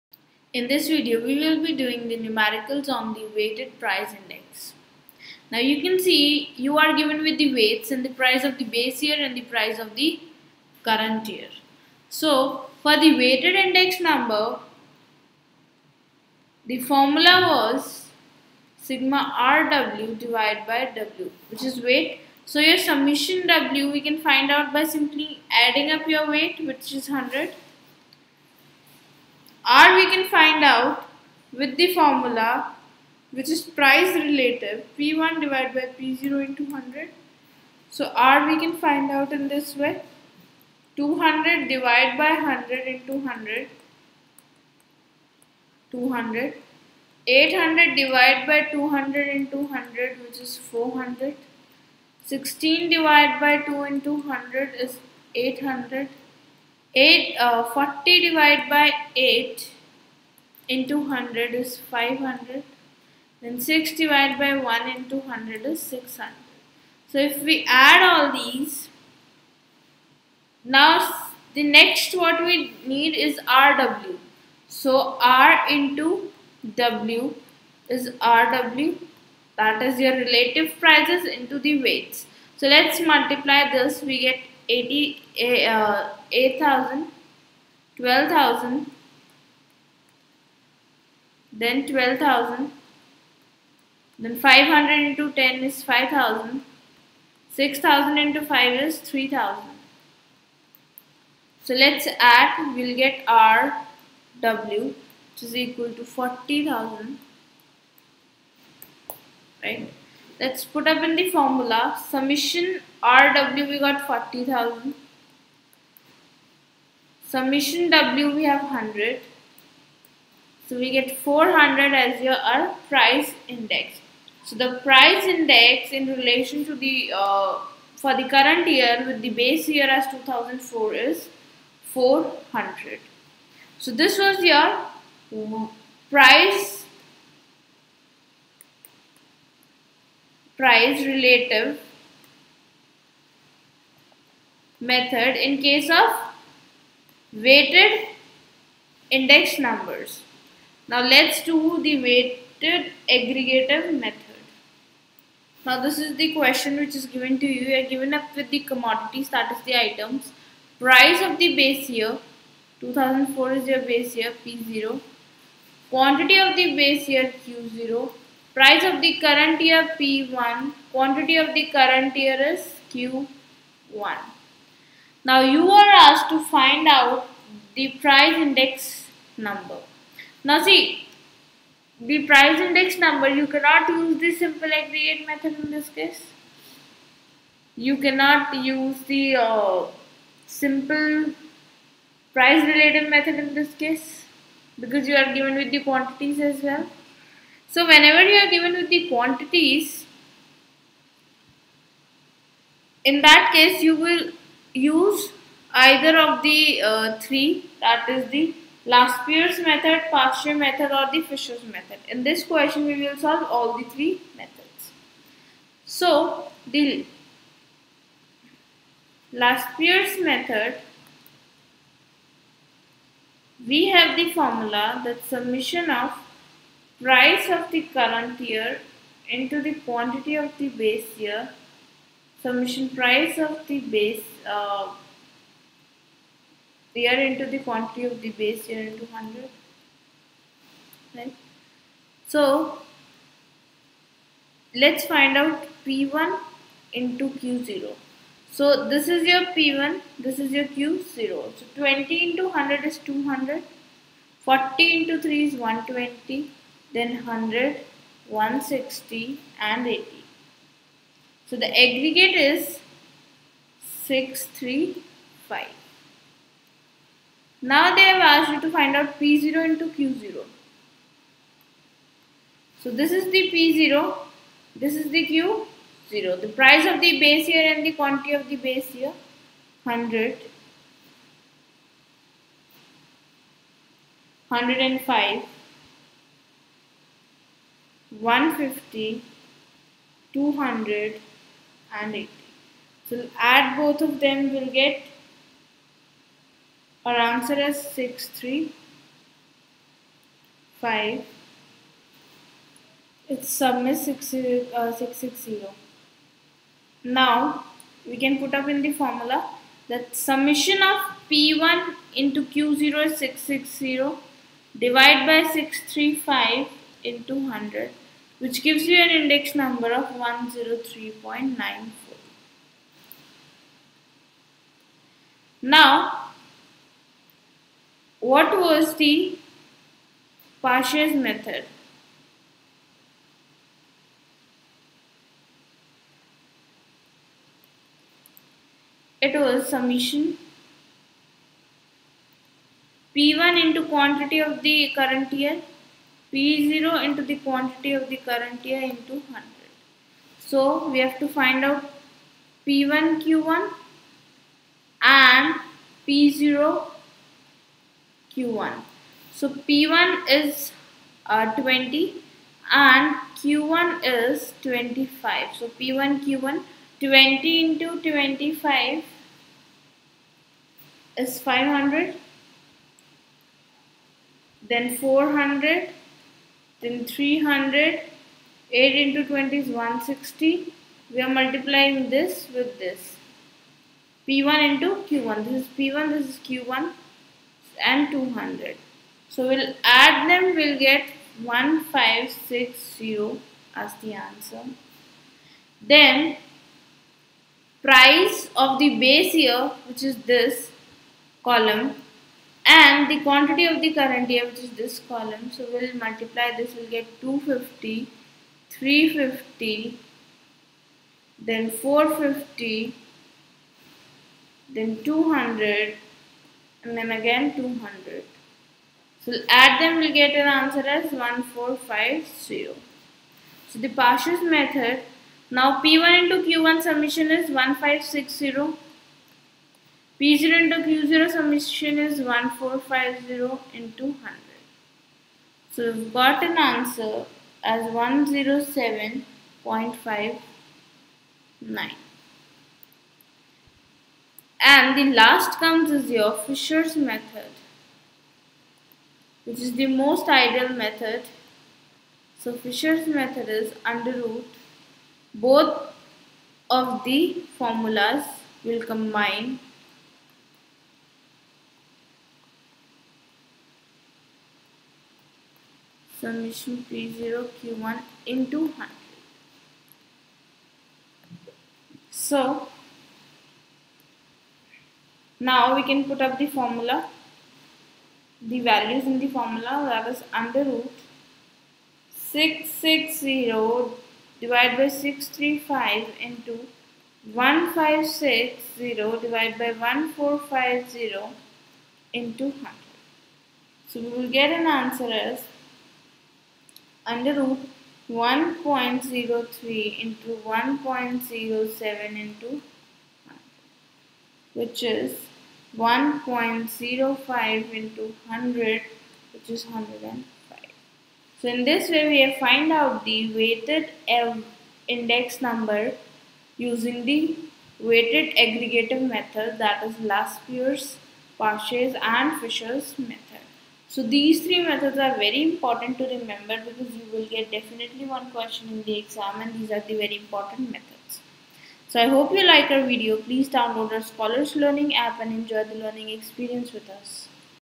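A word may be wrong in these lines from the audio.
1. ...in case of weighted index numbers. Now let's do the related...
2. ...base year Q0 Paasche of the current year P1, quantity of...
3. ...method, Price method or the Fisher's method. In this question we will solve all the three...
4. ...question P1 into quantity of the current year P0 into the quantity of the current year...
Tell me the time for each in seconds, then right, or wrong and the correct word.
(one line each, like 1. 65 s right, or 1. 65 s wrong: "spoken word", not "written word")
1. 145 s wrong: "weighted", not "related"
2. 166 s wrong: "Price", not "Paasche"
3. 209 s wrong: "Paasche", not "Price"
4. 339 s wrong: "summation", not "question".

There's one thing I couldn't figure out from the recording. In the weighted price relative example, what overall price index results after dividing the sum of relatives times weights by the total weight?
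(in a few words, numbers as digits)
400.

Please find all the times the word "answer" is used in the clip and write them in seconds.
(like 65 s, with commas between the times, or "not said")
297 s, 394 s, 420 s, 436 s, 494 s.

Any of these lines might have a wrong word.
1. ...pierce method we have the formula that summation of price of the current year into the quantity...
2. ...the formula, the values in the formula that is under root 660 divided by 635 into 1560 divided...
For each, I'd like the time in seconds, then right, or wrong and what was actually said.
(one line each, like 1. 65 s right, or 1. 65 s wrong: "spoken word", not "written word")
1. 219 s right
2. 476 s right.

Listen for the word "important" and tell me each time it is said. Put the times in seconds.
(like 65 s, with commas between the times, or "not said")
525 s, 530 s.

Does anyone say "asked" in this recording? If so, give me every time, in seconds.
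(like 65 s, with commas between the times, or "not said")
175 s, 268 s.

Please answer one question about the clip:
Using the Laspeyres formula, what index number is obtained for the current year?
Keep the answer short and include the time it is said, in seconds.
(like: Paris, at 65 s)
103.94, at 320 s.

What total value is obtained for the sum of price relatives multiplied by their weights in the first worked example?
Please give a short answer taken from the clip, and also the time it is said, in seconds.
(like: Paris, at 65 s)
40,000, at 114 s.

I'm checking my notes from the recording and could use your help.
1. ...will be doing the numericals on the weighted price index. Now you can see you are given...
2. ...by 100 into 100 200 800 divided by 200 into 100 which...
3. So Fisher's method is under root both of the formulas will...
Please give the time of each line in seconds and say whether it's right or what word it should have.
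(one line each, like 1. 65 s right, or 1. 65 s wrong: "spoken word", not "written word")
1. 1 s right
2. 42 s right
3. 452 s right.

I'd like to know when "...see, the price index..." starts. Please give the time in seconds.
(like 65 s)
180 s.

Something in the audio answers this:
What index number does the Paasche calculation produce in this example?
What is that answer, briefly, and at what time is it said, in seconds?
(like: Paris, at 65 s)
107.59, at 437 s.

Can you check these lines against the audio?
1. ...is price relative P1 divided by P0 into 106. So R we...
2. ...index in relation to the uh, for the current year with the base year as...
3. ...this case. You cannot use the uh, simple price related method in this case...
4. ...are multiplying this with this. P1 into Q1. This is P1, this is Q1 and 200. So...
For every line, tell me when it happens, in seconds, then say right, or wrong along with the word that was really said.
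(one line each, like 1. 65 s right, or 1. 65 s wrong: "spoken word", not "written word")
1. 33 s wrong: "100", not "106"
2. 125 s right
3. 185 s right
4. 381 s right.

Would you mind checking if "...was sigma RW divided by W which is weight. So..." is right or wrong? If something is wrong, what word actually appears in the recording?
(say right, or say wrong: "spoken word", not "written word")
right.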